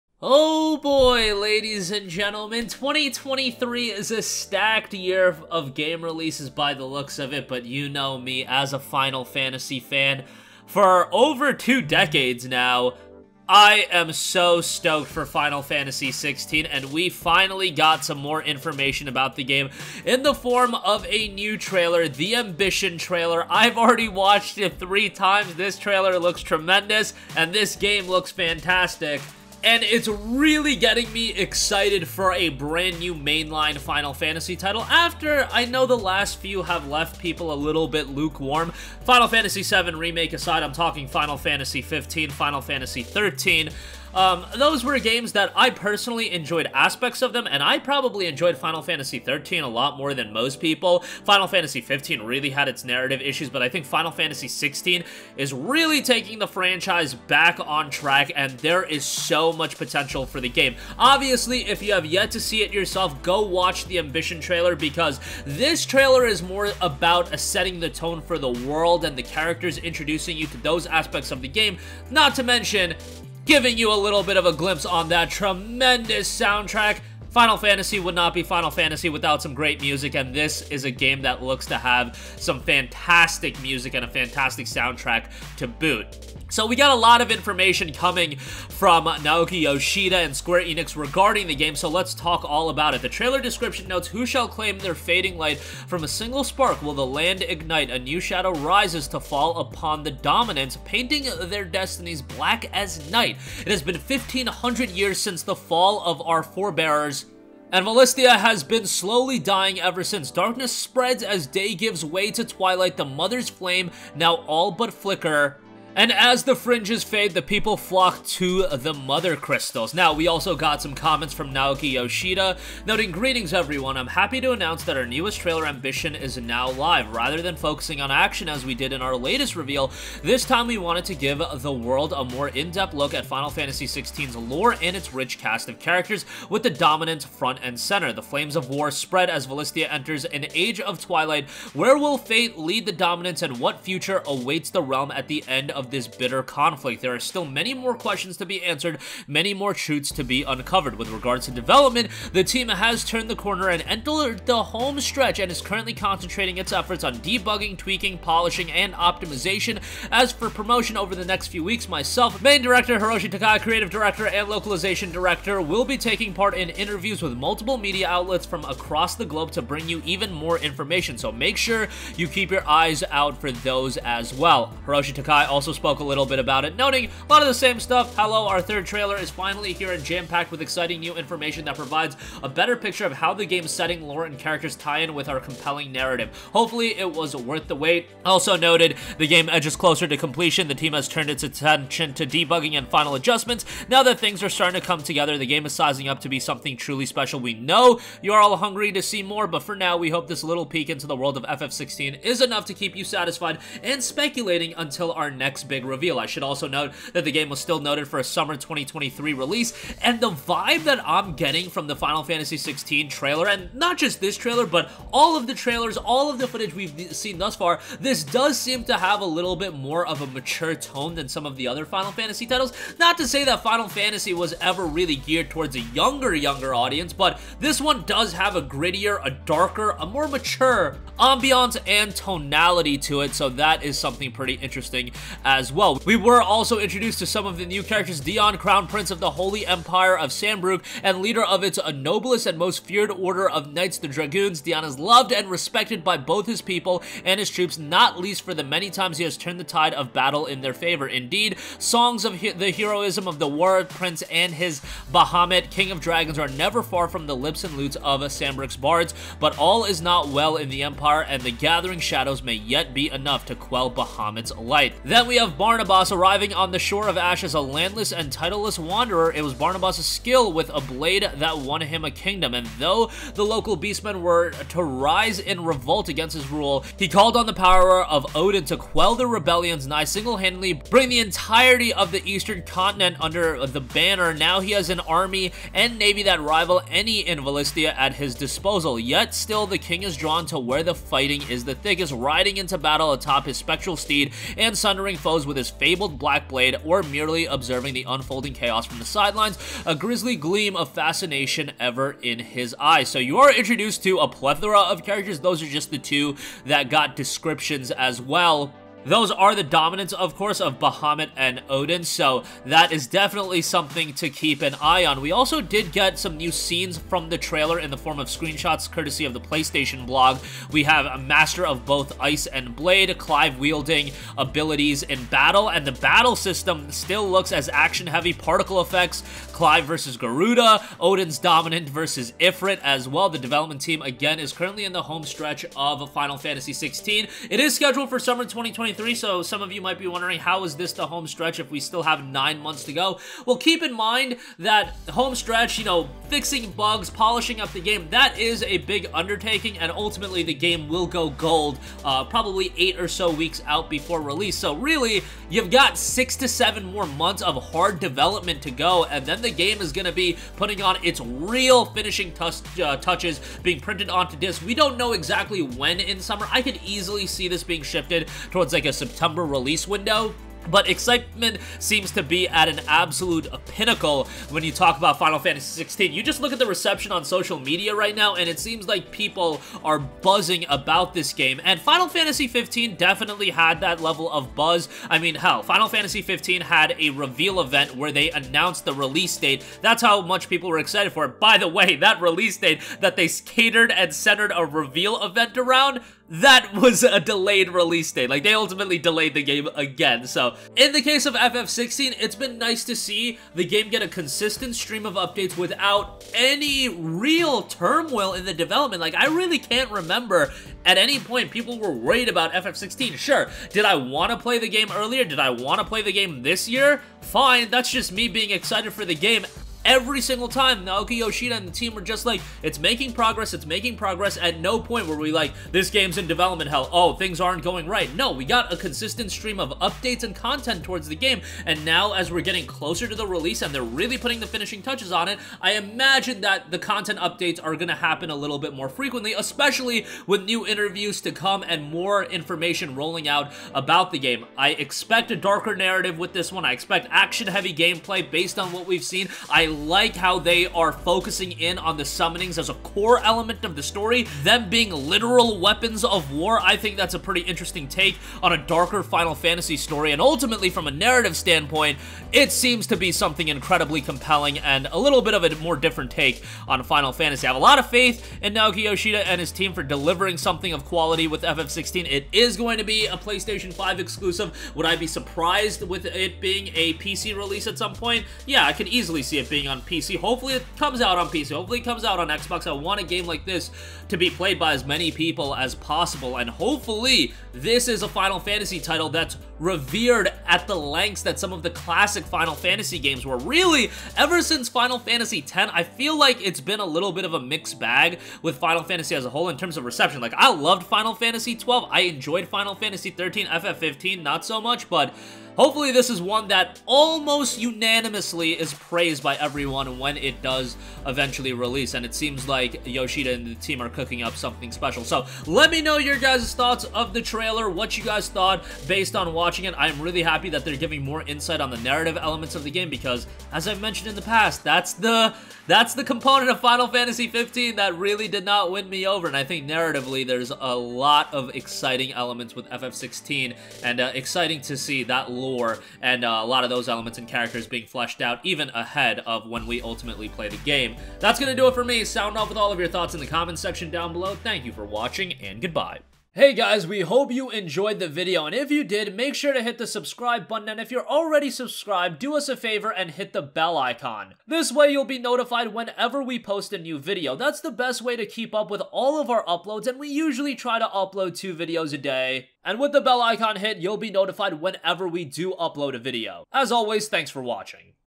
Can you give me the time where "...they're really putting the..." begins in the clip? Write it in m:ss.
7:13.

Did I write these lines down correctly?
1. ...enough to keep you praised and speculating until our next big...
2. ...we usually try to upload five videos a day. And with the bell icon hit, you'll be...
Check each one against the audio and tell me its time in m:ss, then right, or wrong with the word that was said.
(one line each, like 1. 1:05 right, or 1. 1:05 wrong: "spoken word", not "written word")
1. 3:22 wrong: "satisfied", not "praised"
2. 9:19 wrong: "two", not "five".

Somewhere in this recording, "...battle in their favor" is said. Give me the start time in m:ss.
4:10.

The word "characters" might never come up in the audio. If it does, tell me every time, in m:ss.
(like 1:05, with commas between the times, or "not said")
1:09, 2:15, 3:04, 3:57, 5:05, 8:57.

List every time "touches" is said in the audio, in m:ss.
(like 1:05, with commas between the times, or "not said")
6:02, 7:14.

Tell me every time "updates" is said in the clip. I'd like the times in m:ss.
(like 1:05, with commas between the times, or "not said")
6:45, 7:09, 7:17.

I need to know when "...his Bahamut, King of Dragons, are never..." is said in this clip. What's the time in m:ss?
4:14.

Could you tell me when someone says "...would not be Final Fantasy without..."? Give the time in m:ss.
1:17.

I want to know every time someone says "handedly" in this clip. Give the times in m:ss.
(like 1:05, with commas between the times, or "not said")
4:40.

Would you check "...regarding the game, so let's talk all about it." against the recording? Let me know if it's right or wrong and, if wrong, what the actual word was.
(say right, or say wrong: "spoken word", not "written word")
right.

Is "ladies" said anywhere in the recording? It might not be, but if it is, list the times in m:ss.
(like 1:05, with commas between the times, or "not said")
0:01.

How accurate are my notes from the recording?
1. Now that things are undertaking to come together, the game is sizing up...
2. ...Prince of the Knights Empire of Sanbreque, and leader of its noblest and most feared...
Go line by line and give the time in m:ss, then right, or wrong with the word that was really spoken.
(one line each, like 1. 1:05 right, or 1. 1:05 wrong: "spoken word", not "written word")
1. 3:13 wrong: "starting", not "undertaking"
2. 3:58 wrong: "Holy", not "Knights".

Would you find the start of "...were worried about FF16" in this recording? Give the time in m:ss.
6:51.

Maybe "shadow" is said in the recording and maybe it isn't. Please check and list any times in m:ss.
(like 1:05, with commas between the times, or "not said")
1:38, 4:21.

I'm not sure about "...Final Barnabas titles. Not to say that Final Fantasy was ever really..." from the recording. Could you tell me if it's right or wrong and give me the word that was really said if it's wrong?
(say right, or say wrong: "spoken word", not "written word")
wrong: "Fantasy", not "Barnabas".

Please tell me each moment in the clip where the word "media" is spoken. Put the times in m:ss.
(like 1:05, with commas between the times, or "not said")
2:47, 6:17.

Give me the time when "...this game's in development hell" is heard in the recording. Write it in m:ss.
7:05.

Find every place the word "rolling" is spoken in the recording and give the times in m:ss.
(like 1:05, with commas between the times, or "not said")
7:22.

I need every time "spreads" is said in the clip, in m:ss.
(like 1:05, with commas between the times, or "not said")
1:50, 2:18.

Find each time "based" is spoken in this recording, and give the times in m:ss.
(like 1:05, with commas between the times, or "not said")
7:28, 8:38.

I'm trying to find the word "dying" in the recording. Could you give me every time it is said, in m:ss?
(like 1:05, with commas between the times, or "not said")
1:49.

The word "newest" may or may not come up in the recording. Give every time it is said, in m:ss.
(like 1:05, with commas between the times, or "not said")
2:05.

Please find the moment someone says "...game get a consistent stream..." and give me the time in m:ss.
6:43.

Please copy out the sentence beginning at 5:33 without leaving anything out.
The development team, again, is currently in the home stretch of Final Fantasy 16.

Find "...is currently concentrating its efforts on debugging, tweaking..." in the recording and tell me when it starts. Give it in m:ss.
2:35.